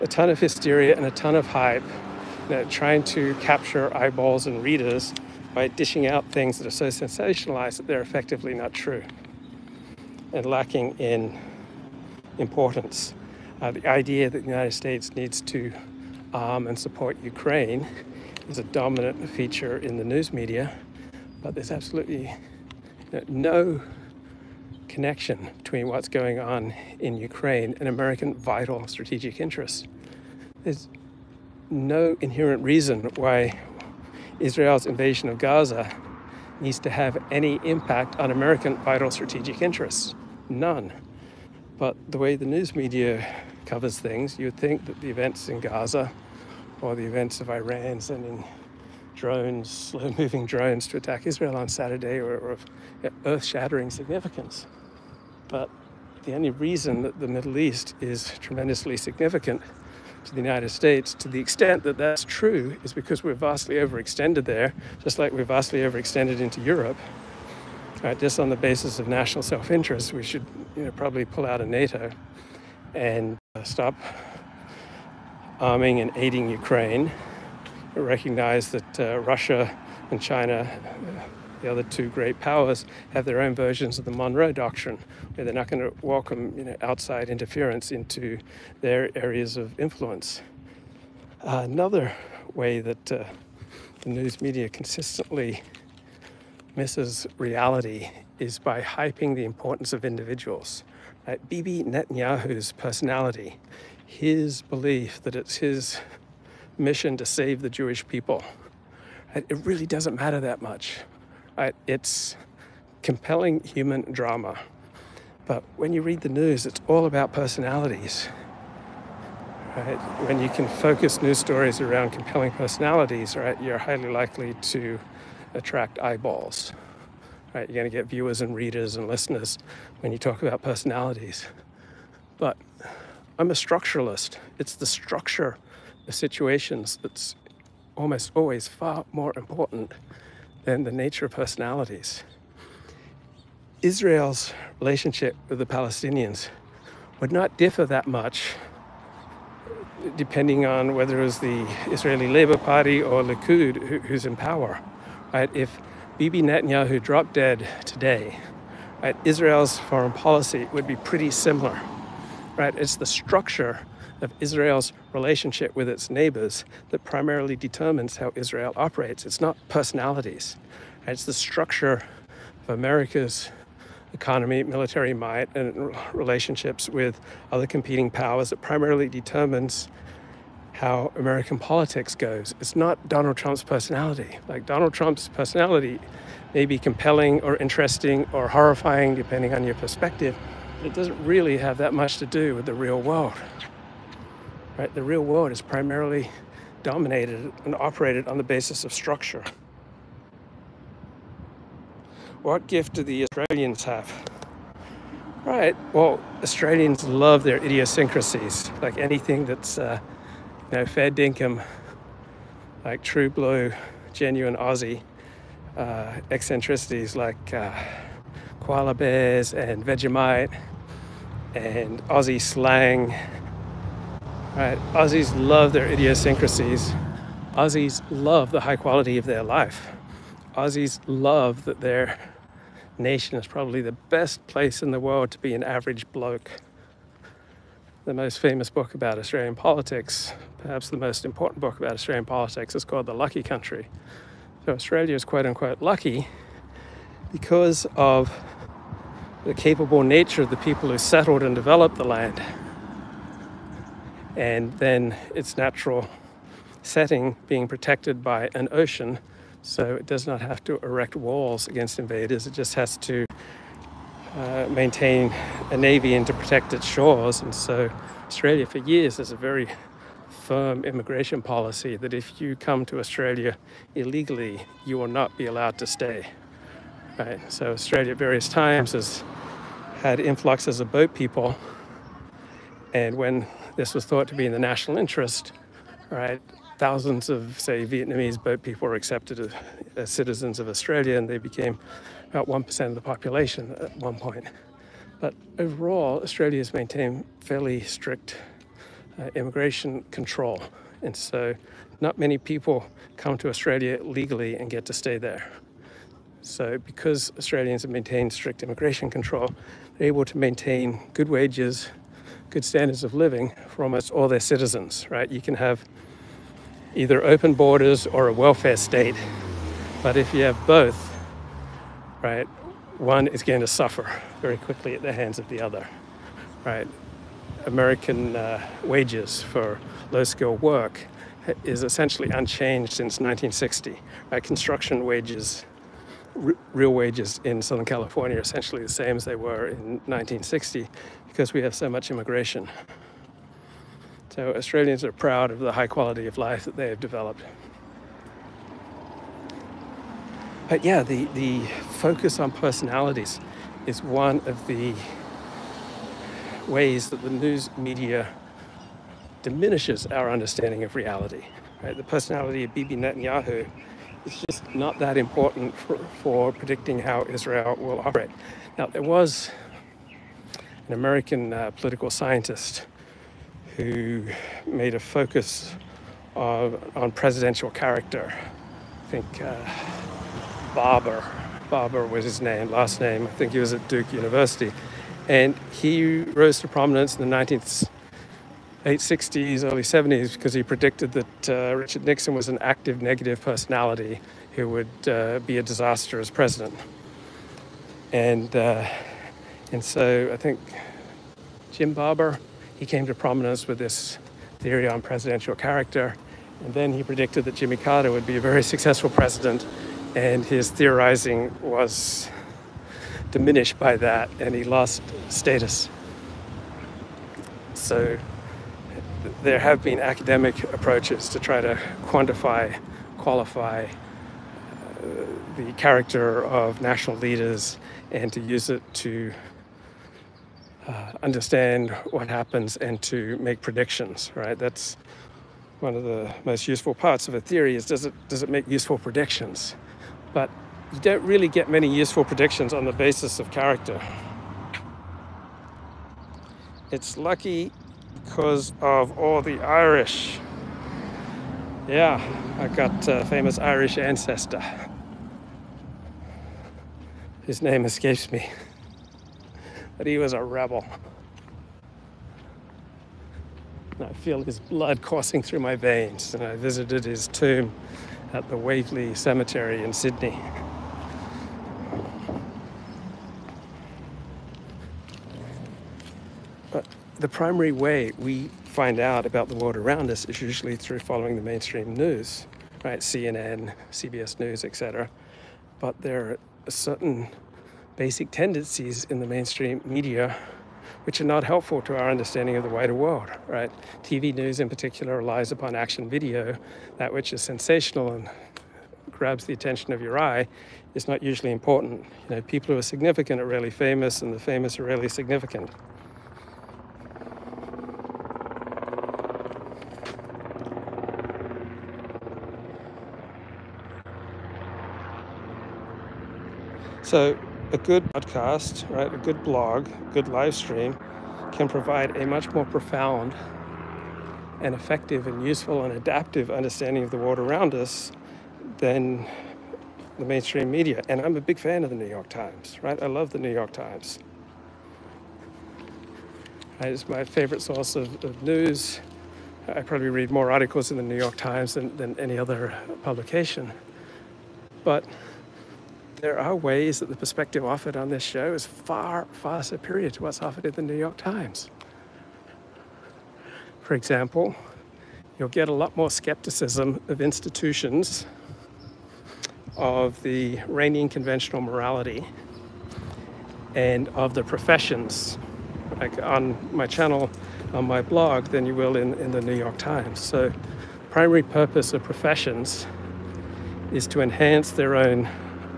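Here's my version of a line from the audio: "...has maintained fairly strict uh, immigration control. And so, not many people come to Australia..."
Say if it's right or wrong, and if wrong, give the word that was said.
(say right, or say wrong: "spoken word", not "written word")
right.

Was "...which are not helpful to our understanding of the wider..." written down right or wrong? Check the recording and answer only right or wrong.
right.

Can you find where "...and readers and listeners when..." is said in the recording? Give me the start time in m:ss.
2:08.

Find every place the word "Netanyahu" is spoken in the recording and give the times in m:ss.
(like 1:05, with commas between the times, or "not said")
1:41, 2:36, 6:02.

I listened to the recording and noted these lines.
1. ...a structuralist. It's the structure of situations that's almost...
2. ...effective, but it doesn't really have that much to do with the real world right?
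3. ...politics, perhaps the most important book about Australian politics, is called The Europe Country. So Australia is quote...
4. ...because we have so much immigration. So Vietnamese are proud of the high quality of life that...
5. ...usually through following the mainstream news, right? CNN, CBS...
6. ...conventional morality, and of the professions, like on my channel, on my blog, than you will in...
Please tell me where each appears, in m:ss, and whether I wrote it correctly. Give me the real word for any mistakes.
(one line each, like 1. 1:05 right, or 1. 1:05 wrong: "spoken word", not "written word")
1. 2:13 right
2. 3:09 wrong: "perspective", not "effective"
3. 3:59 wrong: "Lucky", not "Europe"
4. 5:41 wrong: "Australians", not "Vietnamese"
5. 8:00 right
6. 9:21 right.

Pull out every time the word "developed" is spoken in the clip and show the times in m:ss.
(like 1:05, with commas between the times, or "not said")
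4:11, 5:47.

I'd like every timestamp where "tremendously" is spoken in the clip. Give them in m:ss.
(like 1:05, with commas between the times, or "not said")
0:58.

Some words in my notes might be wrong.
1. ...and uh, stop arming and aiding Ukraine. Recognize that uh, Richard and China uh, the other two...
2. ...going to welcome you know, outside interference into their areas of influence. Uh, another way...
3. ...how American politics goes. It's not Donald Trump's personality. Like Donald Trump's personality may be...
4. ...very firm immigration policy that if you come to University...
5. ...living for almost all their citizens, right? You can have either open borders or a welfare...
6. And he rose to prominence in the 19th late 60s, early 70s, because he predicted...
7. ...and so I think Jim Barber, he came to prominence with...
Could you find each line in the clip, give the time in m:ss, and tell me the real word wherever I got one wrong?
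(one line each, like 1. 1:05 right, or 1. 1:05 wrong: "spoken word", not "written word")
1. 1:12 wrong: "Russia", not "Richard"
2. 1:25 right
3. 3:00 right
4. 4:29 wrong: "Australia", not "University"
5. 5:13 right
6. 6:25 right
7. 6:39 right.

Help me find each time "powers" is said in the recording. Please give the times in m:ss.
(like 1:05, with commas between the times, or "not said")
1:22, 2:34, 2:58.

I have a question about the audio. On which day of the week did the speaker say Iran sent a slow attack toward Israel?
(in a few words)
Saturday.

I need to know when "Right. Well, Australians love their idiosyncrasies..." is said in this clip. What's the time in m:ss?
3:25.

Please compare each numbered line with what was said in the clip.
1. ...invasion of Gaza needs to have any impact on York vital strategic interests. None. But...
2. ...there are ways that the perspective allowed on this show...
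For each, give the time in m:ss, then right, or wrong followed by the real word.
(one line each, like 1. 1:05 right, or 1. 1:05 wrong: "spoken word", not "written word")
1. 0:34 wrong: "American", not "York"
2. 9:06 wrong: "offered", not "allowed".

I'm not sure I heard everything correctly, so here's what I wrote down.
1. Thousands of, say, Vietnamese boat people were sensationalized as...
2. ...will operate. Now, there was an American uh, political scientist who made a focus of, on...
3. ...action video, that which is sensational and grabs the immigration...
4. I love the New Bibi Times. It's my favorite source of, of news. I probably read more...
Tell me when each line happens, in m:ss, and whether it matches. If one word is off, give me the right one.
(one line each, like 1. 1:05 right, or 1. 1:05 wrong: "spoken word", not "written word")
1. 4:46 wrong: "accepted", not "sensationalized"
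2. 6:07 right
3. 8:15 wrong: "attention", not "immigration"
4. 8:53 wrong: "York", not "Bibi".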